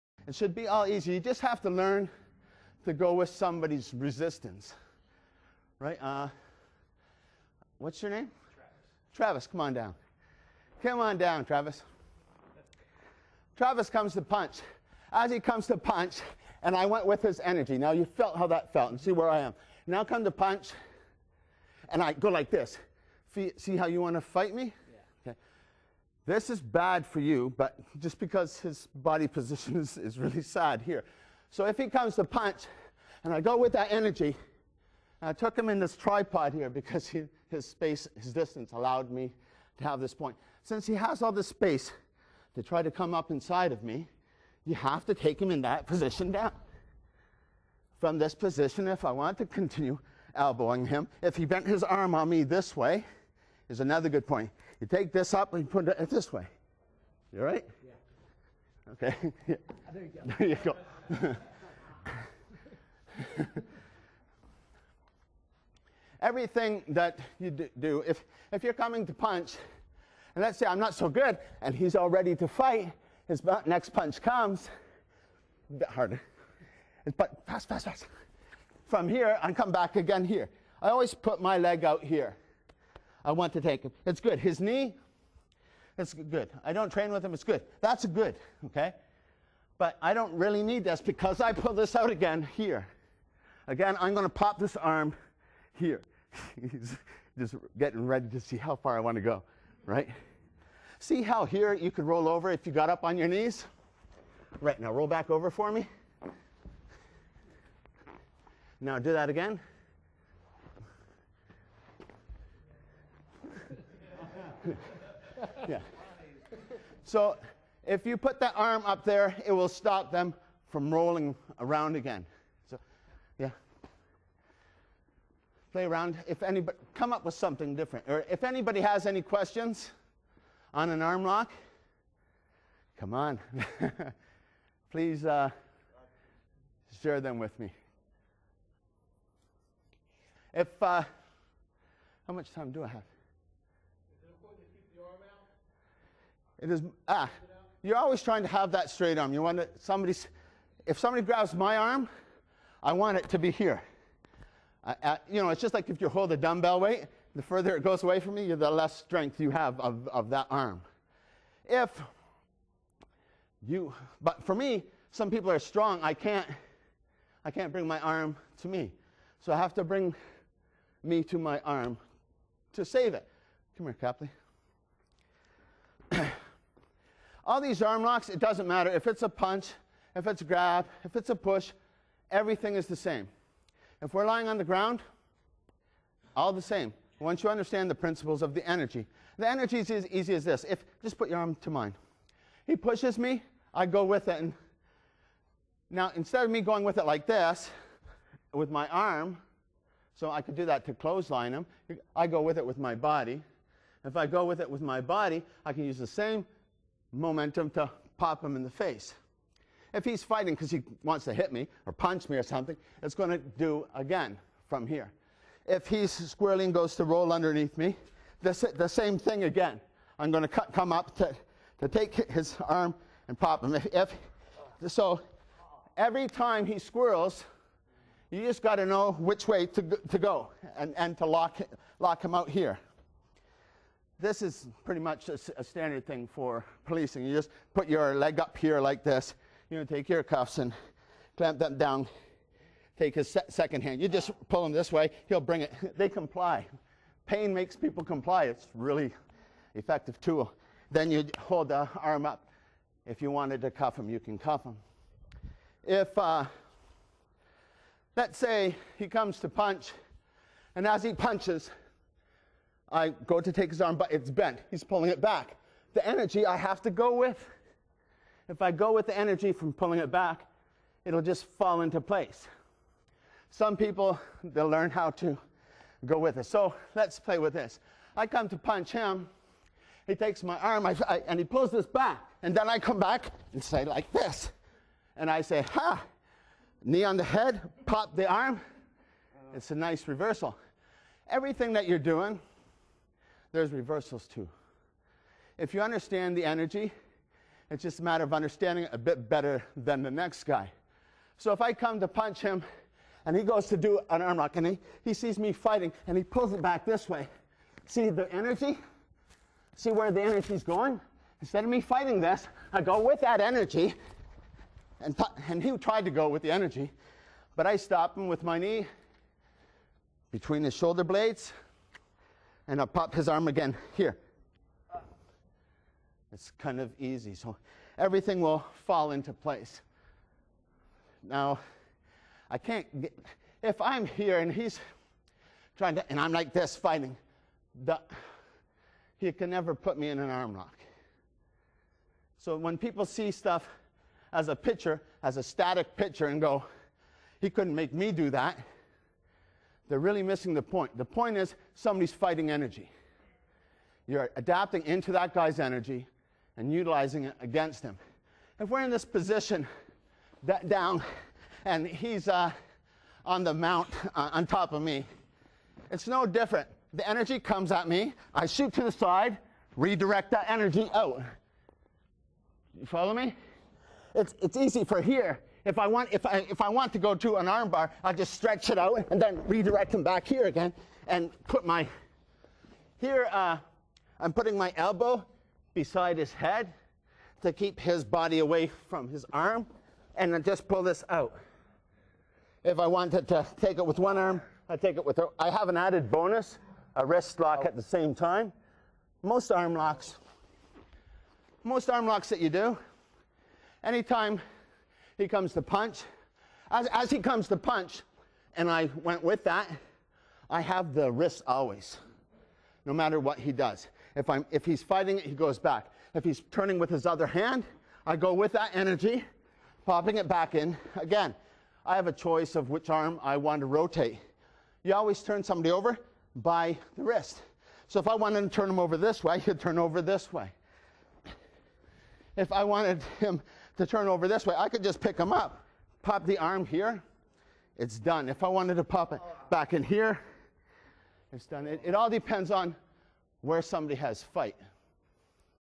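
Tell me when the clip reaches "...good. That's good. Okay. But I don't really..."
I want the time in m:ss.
1:27.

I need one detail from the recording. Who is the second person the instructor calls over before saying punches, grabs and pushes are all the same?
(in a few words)
Copley.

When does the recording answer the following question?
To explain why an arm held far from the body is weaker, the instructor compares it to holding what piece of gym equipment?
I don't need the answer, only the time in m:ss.
2:36.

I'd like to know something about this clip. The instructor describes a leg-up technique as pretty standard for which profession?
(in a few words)
policing.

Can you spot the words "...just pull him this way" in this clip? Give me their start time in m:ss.
4:04.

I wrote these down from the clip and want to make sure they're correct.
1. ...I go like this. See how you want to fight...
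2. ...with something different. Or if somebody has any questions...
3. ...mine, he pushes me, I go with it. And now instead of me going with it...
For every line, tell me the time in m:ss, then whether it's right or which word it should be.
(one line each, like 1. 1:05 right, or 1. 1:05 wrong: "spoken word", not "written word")
1. 0:22 right
2. 2:07 wrong: "anybody", not "somebody"
3. 3:11 right.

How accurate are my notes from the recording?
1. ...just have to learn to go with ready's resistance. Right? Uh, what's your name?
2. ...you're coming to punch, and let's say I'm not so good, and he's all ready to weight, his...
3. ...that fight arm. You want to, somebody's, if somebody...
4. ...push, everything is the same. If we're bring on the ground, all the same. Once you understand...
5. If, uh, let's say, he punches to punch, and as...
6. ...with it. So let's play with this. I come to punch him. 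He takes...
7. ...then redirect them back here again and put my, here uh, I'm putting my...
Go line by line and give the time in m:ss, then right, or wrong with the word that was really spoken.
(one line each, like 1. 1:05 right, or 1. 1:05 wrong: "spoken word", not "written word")
1. 0:01 wrong: "somebody", not "ready"
2. 1:08 wrong: "fight", not "weight"
3. 2:28 wrong: "straight", not "fight"
4. 3:01 wrong: "lying", not "bring"
5. 4:15 wrong: "comes", not "punches"
6. 4:36 right
7. 6:19 right.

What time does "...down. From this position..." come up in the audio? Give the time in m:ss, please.
0:46.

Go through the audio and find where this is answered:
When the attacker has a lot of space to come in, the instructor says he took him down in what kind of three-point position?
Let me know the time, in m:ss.
0:35.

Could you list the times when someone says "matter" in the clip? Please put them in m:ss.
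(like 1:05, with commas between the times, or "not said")
2:58, 4:58, 6:52.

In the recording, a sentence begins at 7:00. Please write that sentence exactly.
Again, I have a choice of which arm I want to rotate.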